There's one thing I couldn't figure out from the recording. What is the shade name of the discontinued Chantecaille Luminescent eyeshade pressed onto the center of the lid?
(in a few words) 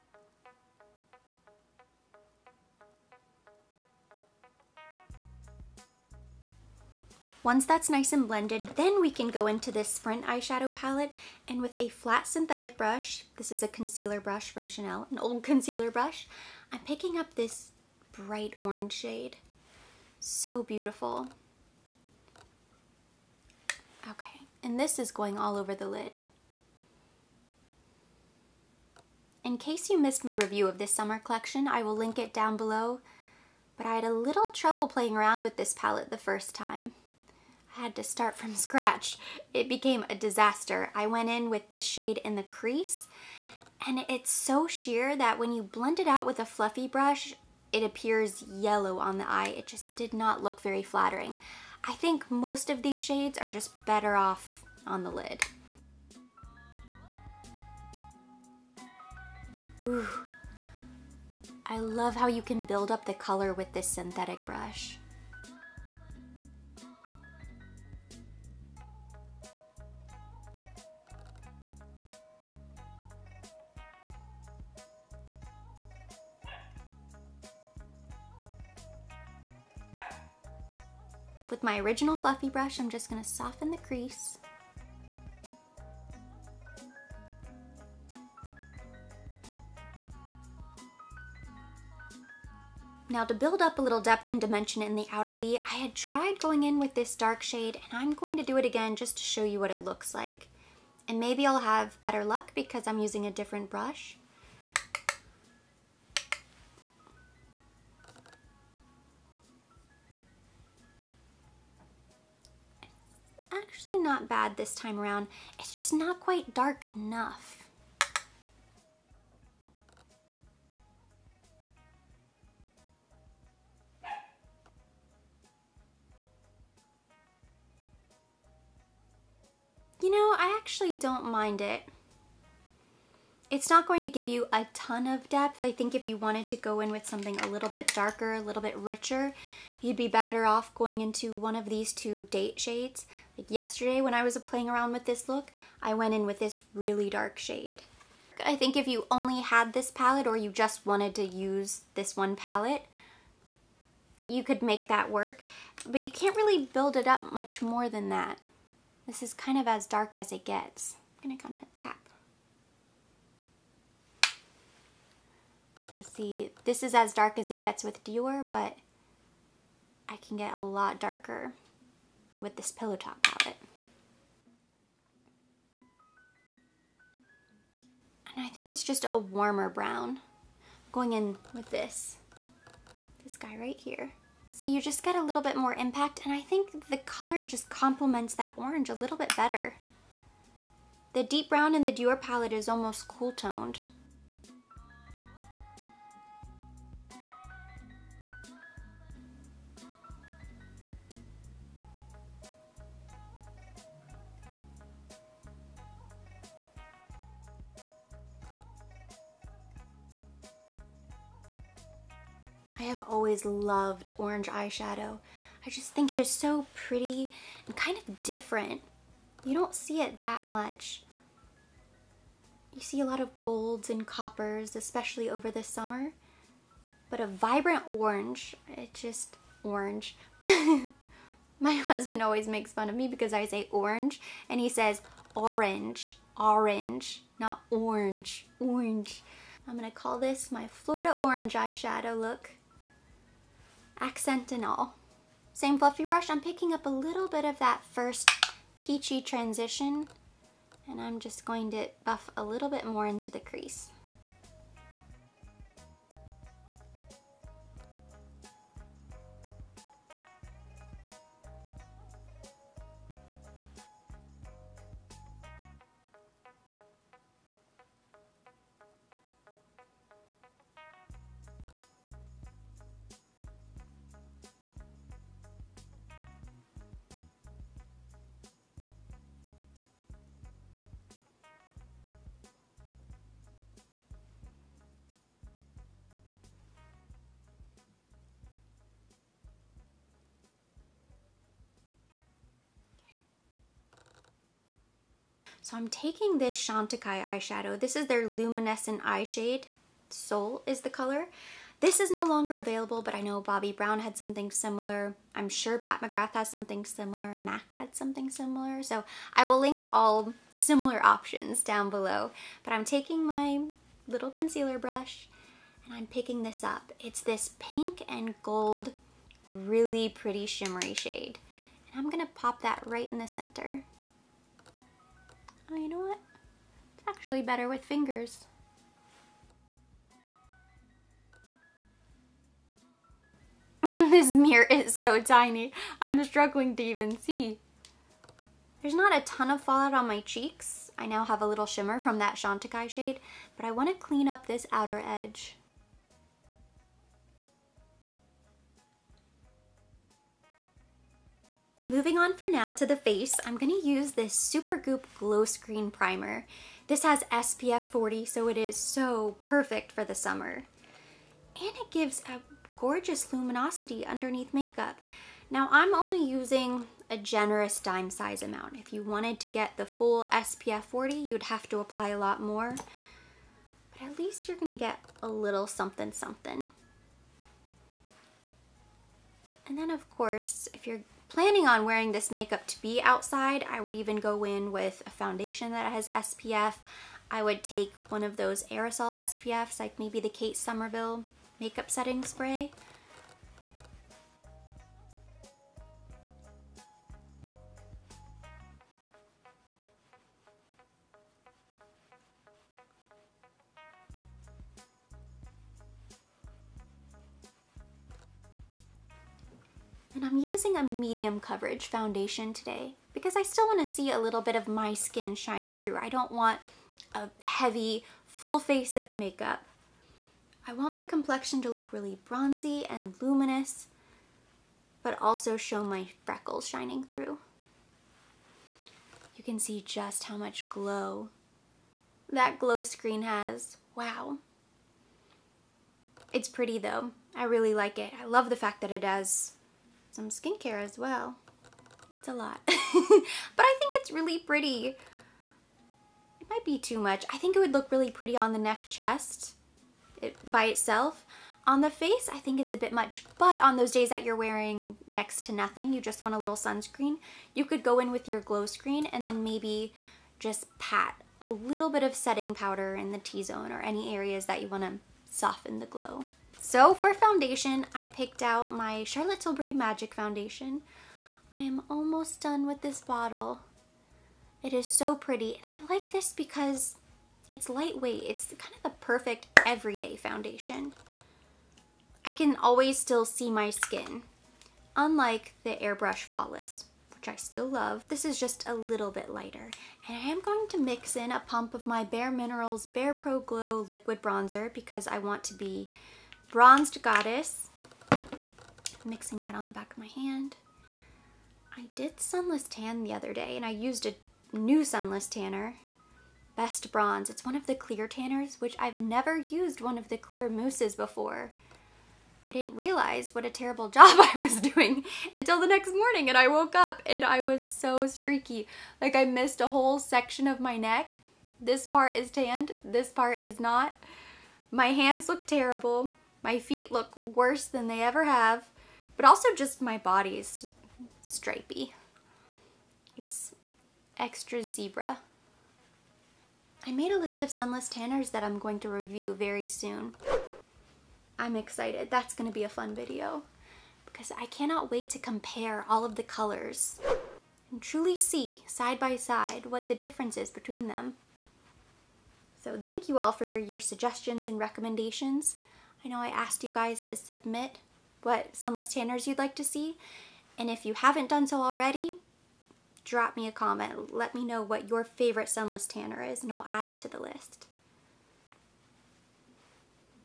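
Soul.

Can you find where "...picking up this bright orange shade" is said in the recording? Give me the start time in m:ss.
0:16.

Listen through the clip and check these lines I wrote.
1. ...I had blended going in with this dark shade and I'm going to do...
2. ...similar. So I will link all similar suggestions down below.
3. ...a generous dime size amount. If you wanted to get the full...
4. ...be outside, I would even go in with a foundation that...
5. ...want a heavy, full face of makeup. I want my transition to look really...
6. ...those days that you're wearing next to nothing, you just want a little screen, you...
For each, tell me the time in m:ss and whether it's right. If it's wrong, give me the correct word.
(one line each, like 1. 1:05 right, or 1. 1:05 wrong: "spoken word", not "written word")
1. 1:35 wrong: "tried", not "blended"
2. 5:08 wrong: "options", not "suggestions"
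3. 6:07 right
4. 6:22 right
5. 6:56 wrong: "complexion", not "transition"
6. 7:33 wrong: "sunscreen", not "screen".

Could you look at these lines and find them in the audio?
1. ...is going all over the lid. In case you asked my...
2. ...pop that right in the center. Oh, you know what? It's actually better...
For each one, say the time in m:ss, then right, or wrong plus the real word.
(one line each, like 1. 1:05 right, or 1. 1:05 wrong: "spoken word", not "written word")
1. 0:24 wrong: "missed", not "asked"
2. 5:22 right.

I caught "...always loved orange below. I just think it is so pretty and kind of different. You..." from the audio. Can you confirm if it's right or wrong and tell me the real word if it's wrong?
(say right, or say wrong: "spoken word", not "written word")
wrong: "eyeshadow", not "below".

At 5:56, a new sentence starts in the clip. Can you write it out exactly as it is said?
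This has SPF 40, so it is so perfect for the summer.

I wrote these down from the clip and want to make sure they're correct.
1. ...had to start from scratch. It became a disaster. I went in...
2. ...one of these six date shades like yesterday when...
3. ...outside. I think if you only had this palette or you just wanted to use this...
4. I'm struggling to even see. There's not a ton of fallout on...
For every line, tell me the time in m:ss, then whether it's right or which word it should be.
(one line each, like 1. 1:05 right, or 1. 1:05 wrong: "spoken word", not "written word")
1. 0:37 right
2. 2:21 wrong: "two", not "six"
3. 2:27 wrong: "shade", not "outside"
4. 5:35 right.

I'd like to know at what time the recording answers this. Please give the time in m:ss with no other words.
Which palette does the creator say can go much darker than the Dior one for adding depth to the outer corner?
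2:52.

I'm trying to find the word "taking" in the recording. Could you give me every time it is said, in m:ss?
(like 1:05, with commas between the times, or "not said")
4:55, 5:12.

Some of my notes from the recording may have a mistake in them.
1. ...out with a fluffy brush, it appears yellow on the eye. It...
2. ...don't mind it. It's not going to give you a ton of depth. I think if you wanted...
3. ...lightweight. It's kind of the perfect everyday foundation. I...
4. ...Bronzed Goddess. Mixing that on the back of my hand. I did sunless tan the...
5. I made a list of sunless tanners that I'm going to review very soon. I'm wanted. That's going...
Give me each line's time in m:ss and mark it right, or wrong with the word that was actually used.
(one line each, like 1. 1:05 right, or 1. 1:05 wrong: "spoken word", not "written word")
1. 0:46 right
2. 2:10 right
3. 7:57 right
4. 8:16 right
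5. 8:56 wrong: "excited", not "wanted".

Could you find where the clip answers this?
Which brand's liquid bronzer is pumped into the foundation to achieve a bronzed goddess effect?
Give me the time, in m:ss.
8:12.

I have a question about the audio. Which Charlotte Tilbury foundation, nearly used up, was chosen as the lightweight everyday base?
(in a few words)
Magic Foundation.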